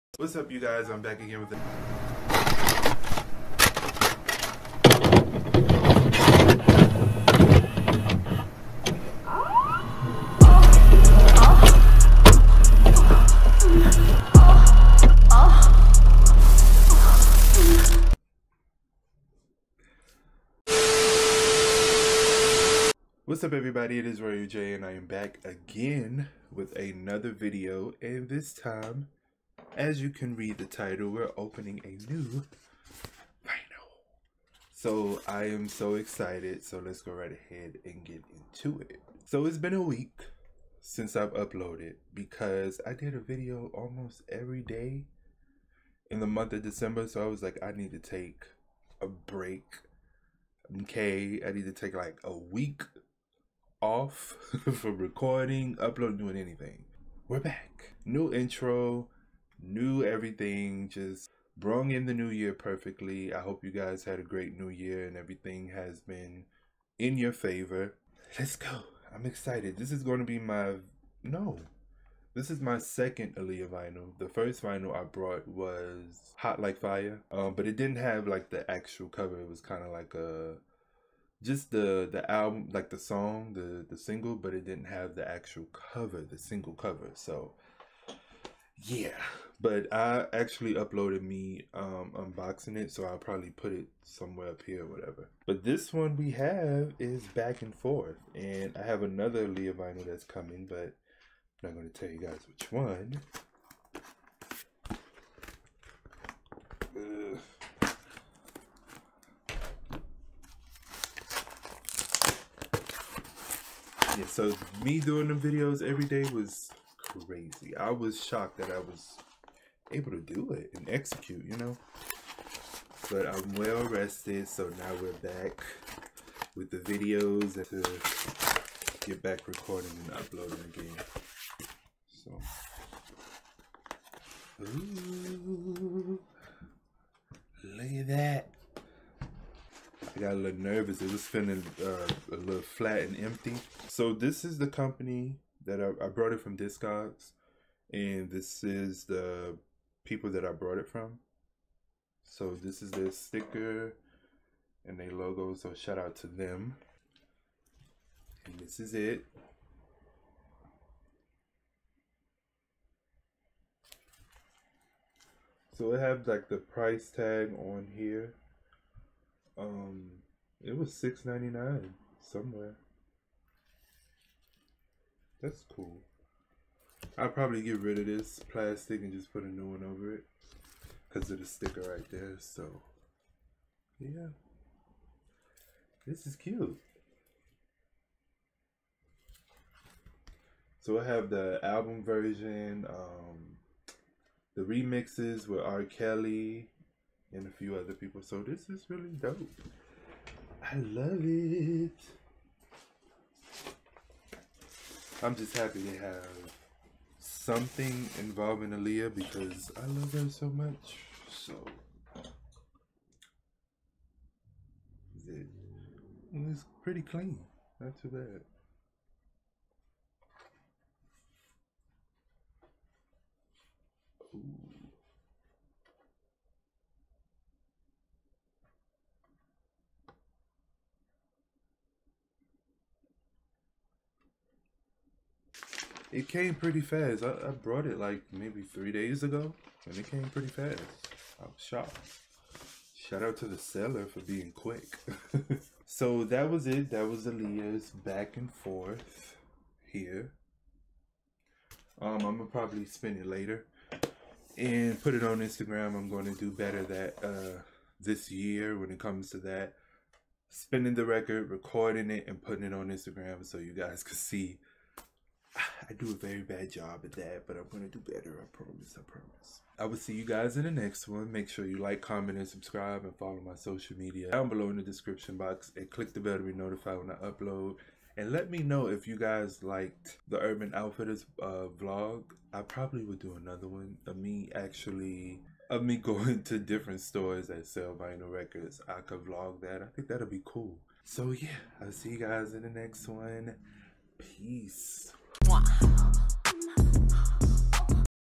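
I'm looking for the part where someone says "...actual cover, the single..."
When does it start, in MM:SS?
01:25.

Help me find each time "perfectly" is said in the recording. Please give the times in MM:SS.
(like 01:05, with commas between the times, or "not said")
01:02.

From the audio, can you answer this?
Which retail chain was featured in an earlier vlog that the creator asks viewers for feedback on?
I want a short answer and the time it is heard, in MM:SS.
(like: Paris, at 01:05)
Urban Outfitters, at 04:40.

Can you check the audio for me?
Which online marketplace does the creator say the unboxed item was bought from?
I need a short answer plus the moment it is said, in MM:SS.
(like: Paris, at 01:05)
Discogs, at 02:26.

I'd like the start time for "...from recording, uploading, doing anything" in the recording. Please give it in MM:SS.
00:54.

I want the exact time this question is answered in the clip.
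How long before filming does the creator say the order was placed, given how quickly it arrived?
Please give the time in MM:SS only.
03:58.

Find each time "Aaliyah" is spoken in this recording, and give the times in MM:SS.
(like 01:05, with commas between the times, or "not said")
01:13, 01:39, 03:28, 04:07.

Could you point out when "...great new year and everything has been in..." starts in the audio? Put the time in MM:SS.
01:04.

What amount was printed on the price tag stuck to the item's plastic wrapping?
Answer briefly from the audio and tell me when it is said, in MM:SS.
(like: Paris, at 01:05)
$6.99, at 02:50.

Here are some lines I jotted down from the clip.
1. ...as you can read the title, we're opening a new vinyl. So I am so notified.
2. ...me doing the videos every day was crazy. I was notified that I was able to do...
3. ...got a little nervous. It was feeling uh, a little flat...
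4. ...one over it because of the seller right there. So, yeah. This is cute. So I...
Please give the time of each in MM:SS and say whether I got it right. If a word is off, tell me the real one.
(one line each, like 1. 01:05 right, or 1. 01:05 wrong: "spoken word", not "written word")
1. 00:29 wrong: "excited", not "notified"
2. 01:54 wrong: "shocked", not "notified"
3. 02:20 right
4. 02:59 wrong: "sticker", not "seller".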